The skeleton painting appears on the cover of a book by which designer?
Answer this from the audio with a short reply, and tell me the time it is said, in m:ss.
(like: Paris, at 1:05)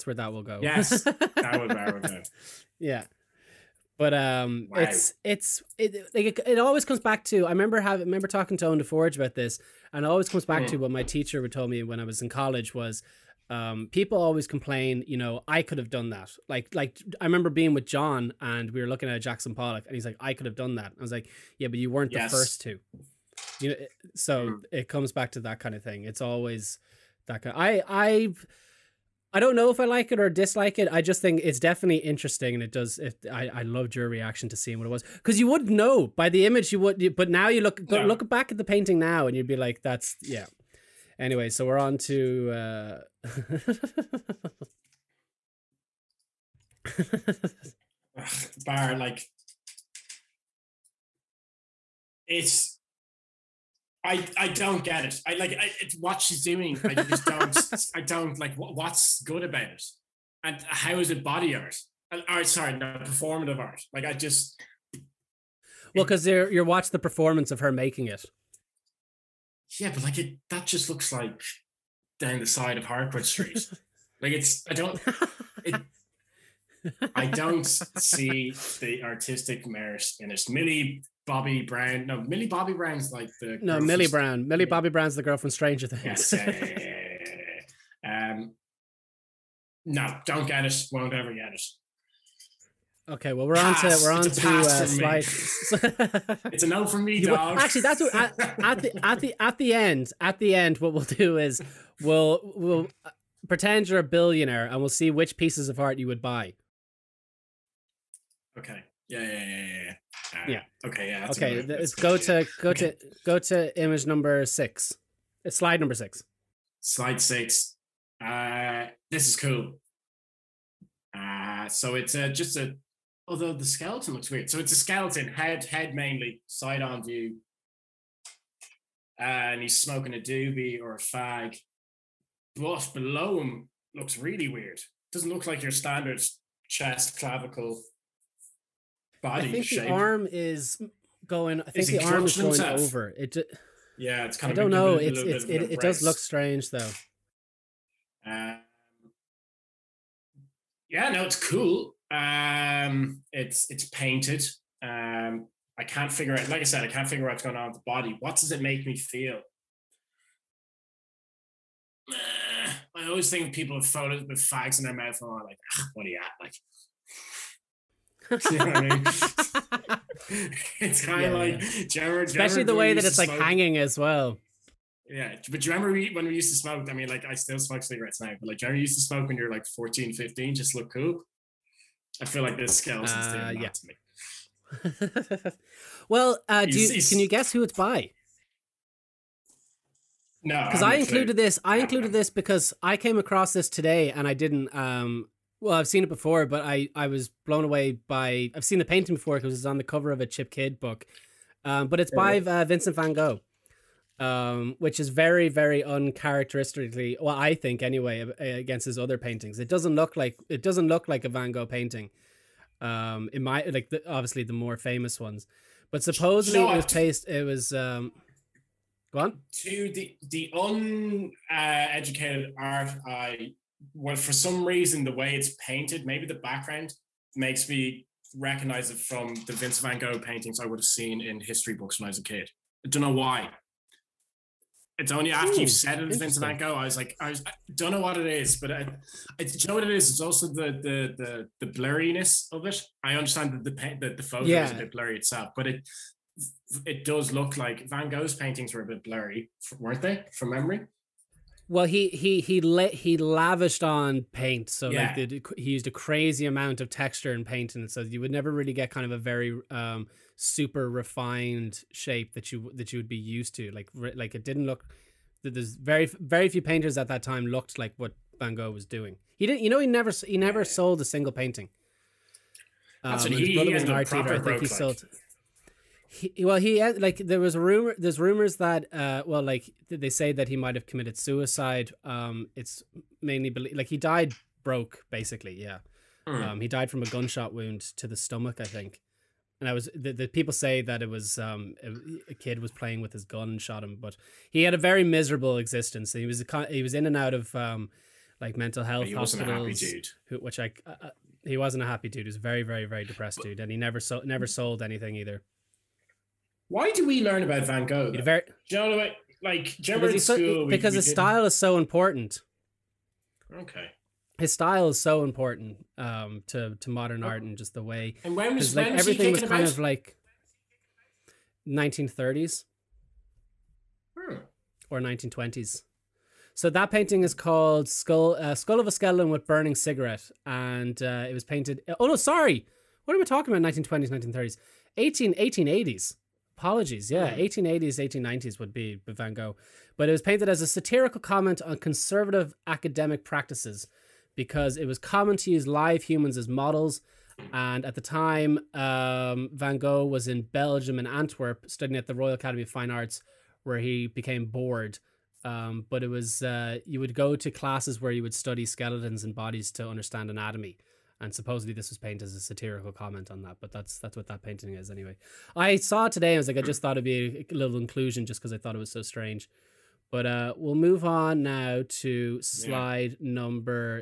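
Chip Kidd, at 3:20.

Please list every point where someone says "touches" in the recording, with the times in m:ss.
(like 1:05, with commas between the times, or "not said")
not said.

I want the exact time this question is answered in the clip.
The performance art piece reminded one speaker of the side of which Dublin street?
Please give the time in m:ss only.
1:12.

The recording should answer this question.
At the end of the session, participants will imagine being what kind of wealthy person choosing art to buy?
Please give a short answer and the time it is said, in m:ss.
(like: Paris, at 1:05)
a billionaire, at 1:44.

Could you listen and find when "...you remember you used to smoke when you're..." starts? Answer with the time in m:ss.
2:58.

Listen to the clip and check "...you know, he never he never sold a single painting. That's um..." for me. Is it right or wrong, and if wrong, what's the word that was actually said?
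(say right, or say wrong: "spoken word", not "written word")
right.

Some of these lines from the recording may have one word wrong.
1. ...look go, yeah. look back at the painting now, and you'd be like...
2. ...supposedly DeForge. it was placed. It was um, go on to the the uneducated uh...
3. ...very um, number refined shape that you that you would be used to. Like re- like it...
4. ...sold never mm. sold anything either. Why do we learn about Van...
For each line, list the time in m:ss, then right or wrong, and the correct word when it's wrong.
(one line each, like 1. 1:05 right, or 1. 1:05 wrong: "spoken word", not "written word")
1. 0:37 right
2. 3:36 wrong: "Shot", not "DeForge"
3. 4:19 wrong: "super", not "number"
4. 5:04 right.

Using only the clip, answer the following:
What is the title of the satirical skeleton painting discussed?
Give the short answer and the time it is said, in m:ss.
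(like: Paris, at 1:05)
Skull of a Skeleton with Burning Cigarette, at 5:28.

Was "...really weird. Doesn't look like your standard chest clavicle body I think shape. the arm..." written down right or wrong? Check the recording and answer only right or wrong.
right.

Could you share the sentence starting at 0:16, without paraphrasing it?
Like, like I remember being with John and we were looking at Jackson Pollock, and he's like, I could have done that.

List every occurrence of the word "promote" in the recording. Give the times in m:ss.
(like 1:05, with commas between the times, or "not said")
not said.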